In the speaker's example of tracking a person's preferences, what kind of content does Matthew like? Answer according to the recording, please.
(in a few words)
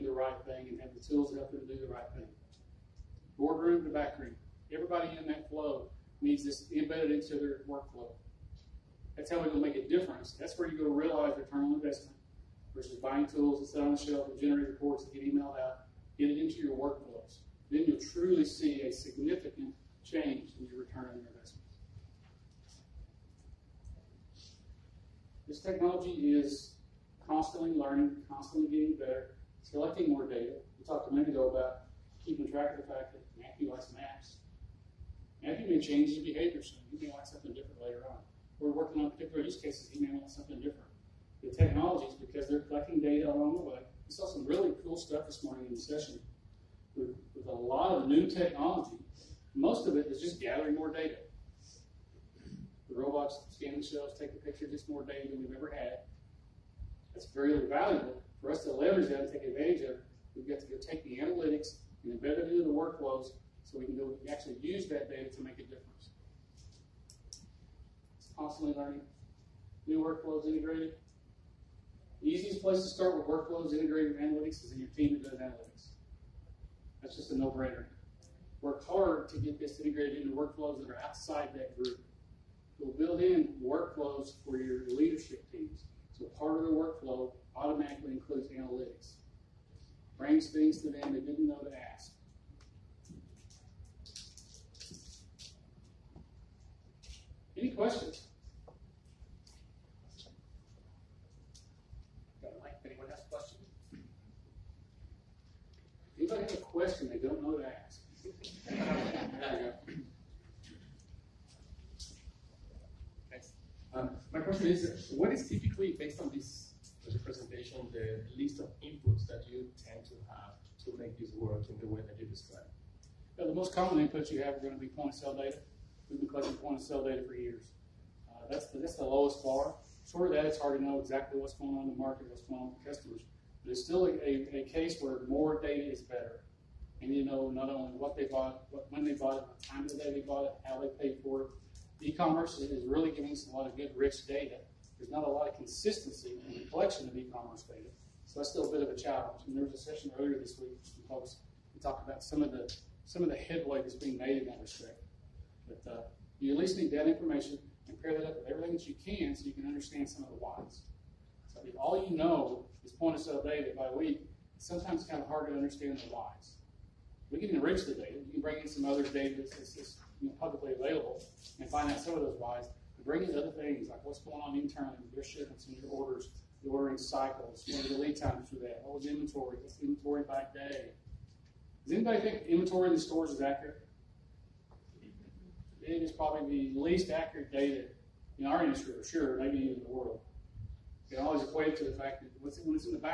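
Maps.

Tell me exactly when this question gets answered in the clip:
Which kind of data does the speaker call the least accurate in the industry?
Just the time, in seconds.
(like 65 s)
182 s.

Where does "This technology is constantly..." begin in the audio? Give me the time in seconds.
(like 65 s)
25 s.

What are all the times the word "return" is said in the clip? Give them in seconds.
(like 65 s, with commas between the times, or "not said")
11 s, 20 s.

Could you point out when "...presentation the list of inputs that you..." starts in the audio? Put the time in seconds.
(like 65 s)
117 s.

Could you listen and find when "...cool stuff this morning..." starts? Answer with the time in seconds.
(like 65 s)
44 s.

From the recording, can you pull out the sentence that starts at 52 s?
The robots scan the shelves, take a picture, just more data than we've ever had.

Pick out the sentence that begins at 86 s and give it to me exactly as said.
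So part of the workflow automatically includes analytics brings things to them they didn't know to ask.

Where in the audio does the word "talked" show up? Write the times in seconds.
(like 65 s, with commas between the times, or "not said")
30 s, 151 s.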